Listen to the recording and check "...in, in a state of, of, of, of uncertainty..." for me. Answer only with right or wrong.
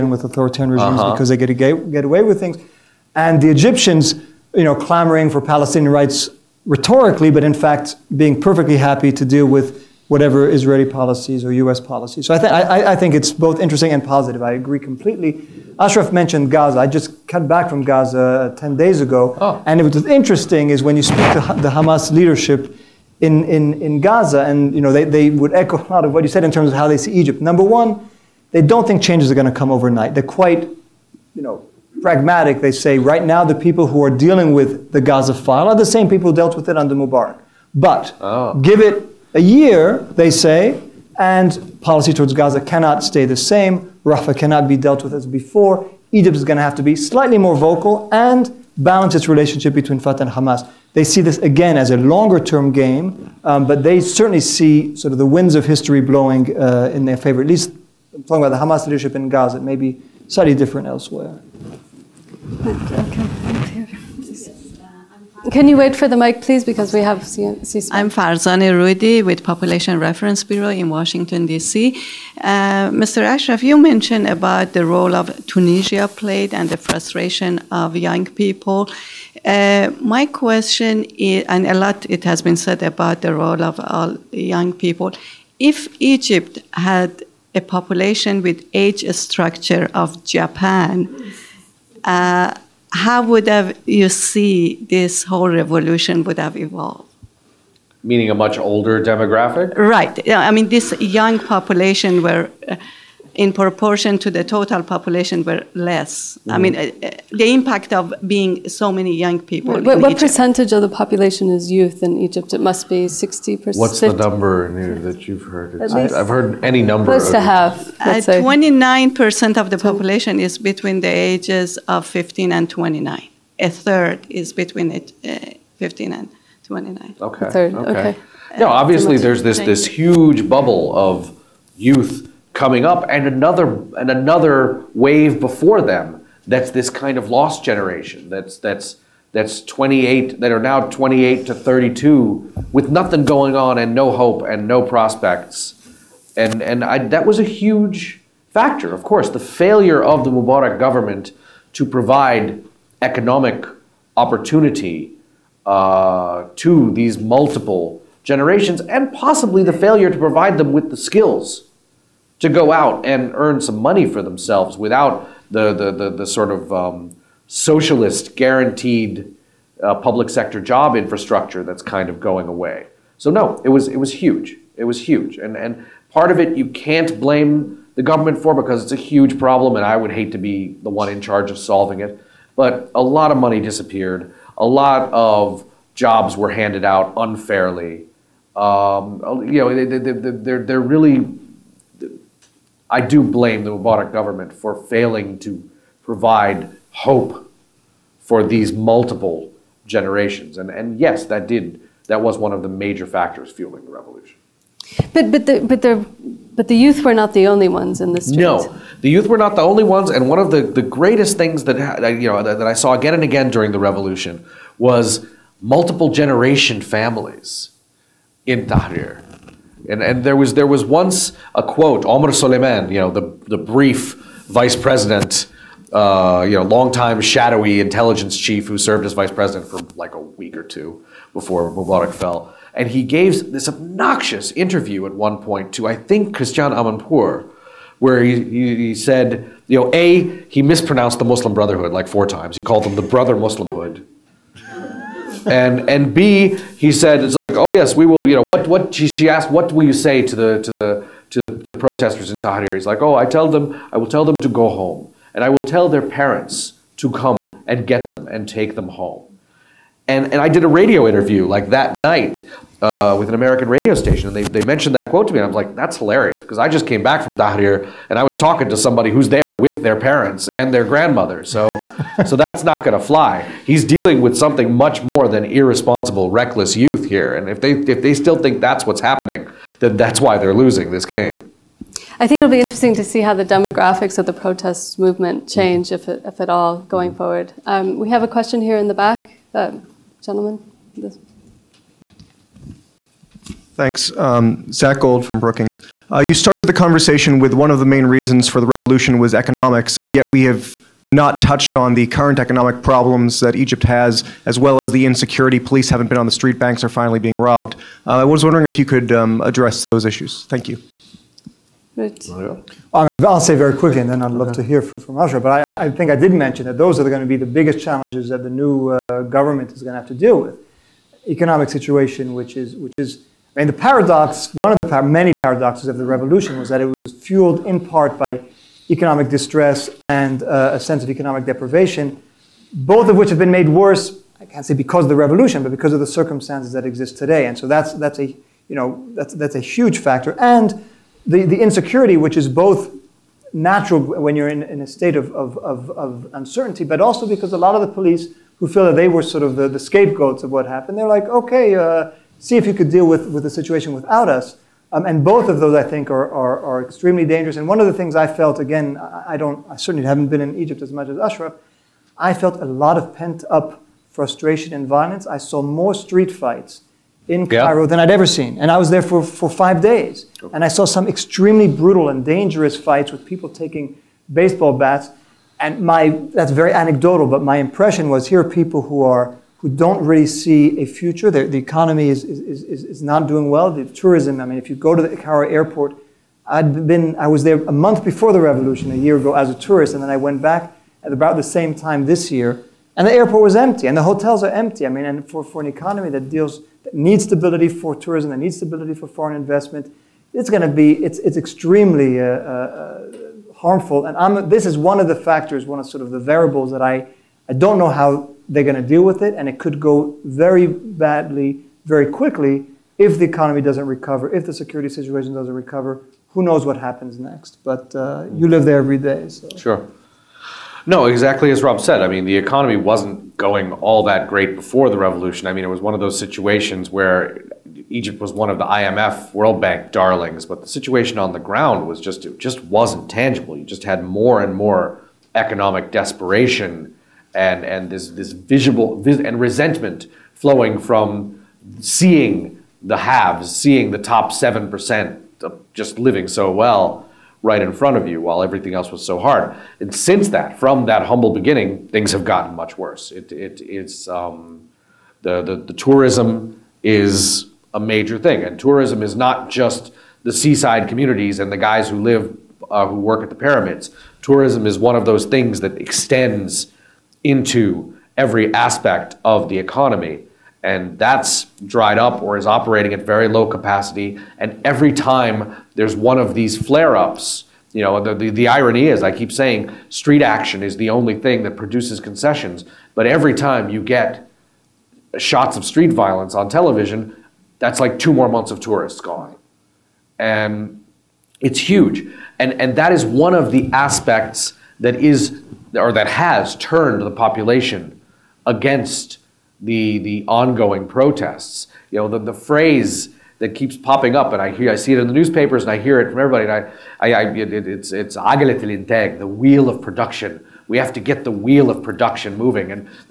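right.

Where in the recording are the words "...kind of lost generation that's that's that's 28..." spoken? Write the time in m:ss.
2:16.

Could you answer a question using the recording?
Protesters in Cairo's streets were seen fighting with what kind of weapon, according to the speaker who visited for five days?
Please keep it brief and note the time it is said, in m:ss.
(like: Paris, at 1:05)
baseball bats, at 6:14.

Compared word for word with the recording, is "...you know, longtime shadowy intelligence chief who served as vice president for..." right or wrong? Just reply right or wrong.
right.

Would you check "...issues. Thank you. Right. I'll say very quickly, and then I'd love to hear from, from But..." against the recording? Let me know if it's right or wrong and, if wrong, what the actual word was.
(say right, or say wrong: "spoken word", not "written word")
right.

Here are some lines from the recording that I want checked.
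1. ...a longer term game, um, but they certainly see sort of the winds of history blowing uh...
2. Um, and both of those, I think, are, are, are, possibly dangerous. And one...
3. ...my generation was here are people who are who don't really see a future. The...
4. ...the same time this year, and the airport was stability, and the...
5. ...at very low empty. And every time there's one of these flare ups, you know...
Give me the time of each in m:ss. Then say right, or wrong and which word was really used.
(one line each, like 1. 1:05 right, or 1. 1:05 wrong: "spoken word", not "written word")
1. 0:51 right
2. 5:54 wrong: "extremely", not "possibly"
3. 6:17 wrong: "impression", not "generation"
4. 6:31 wrong: "empty", not "stability"
5. 7:52 wrong: "capacity", not "empty".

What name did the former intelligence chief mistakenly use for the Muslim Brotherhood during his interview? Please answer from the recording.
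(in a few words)
Brother Muslimhood.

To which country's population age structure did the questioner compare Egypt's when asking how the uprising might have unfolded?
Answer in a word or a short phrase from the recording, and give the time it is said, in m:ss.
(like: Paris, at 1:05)
Japan, at 1:30.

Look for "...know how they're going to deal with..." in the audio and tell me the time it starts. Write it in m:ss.
6:47.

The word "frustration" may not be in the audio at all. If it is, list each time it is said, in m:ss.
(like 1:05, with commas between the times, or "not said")
1:16, 6:04.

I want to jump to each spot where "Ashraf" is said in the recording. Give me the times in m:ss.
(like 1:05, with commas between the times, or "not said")
0:15, 1:13, 6:01.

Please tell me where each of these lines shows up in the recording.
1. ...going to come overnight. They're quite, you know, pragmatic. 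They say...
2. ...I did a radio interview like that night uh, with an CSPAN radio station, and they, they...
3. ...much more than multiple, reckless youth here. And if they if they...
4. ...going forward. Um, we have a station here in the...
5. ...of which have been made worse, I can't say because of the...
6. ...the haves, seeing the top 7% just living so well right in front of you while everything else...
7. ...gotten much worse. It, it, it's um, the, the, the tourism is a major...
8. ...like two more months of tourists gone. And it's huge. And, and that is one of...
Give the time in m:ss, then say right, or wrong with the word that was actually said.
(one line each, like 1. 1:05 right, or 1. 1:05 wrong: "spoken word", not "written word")
1. 0:29 right
2. 4:20 wrong: "American", not "CSPAN"
3. 4:34 wrong: "irresponsible", not "multiple"
4. 4:46 wrong: "question", not "station"
5. 5:33 right
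6. 7:22 right
7. 7:32 right
8. 8:07 right.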